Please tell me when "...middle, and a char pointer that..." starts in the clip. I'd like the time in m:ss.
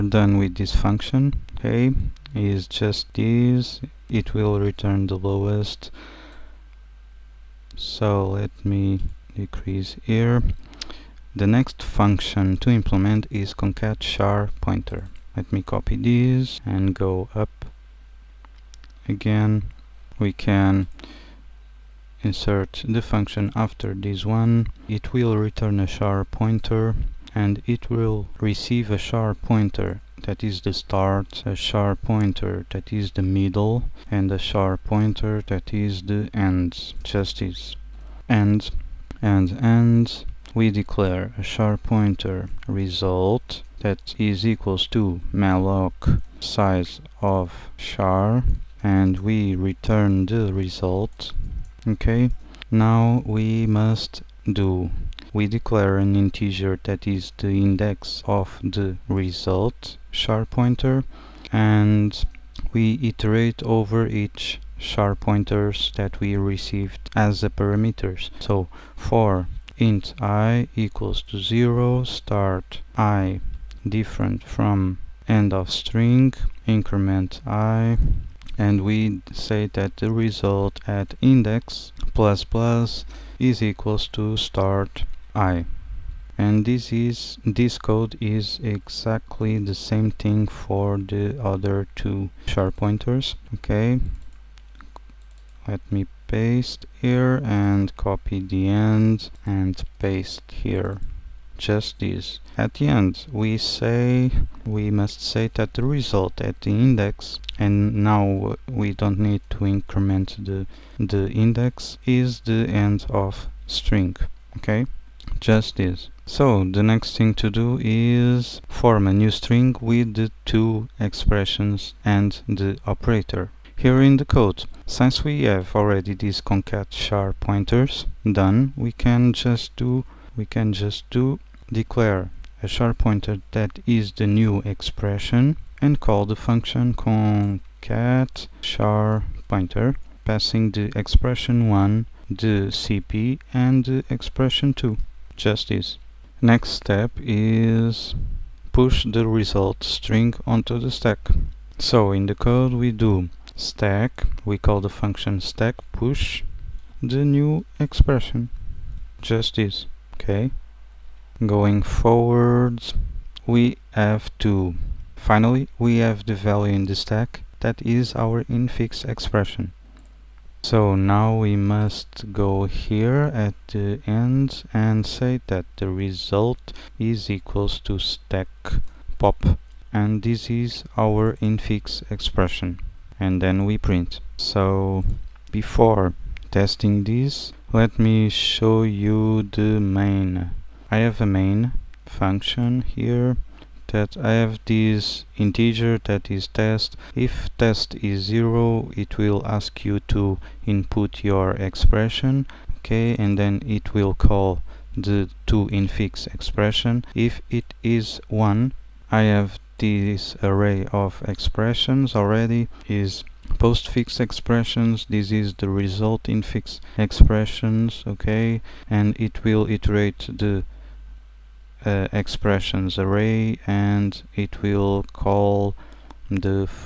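0:33.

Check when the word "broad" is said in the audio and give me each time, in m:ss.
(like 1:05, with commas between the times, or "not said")
not said.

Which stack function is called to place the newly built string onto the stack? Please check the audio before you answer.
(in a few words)
stack push.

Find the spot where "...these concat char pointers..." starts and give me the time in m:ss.
2:06.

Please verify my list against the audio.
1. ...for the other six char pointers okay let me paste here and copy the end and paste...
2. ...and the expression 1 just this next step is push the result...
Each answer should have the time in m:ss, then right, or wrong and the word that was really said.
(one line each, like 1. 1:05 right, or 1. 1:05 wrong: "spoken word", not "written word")
1. 1:30 wrong: "two", not "six"
2. 2:23 wrong: "2", not "1".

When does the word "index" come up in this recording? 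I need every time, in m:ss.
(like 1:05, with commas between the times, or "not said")
0:57, 1:21, 1:46, 1:51.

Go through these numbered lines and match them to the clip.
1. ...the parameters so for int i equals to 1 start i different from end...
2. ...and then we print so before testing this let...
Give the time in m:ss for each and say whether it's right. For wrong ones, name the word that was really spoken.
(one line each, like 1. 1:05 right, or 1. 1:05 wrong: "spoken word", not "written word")
1. 1:07 wrong: "0", not "1"
2. 3:03 right.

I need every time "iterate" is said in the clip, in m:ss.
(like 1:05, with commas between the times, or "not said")
1:03, 3:39.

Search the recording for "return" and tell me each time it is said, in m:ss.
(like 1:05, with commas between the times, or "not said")
0:04, 0:25, 0:49.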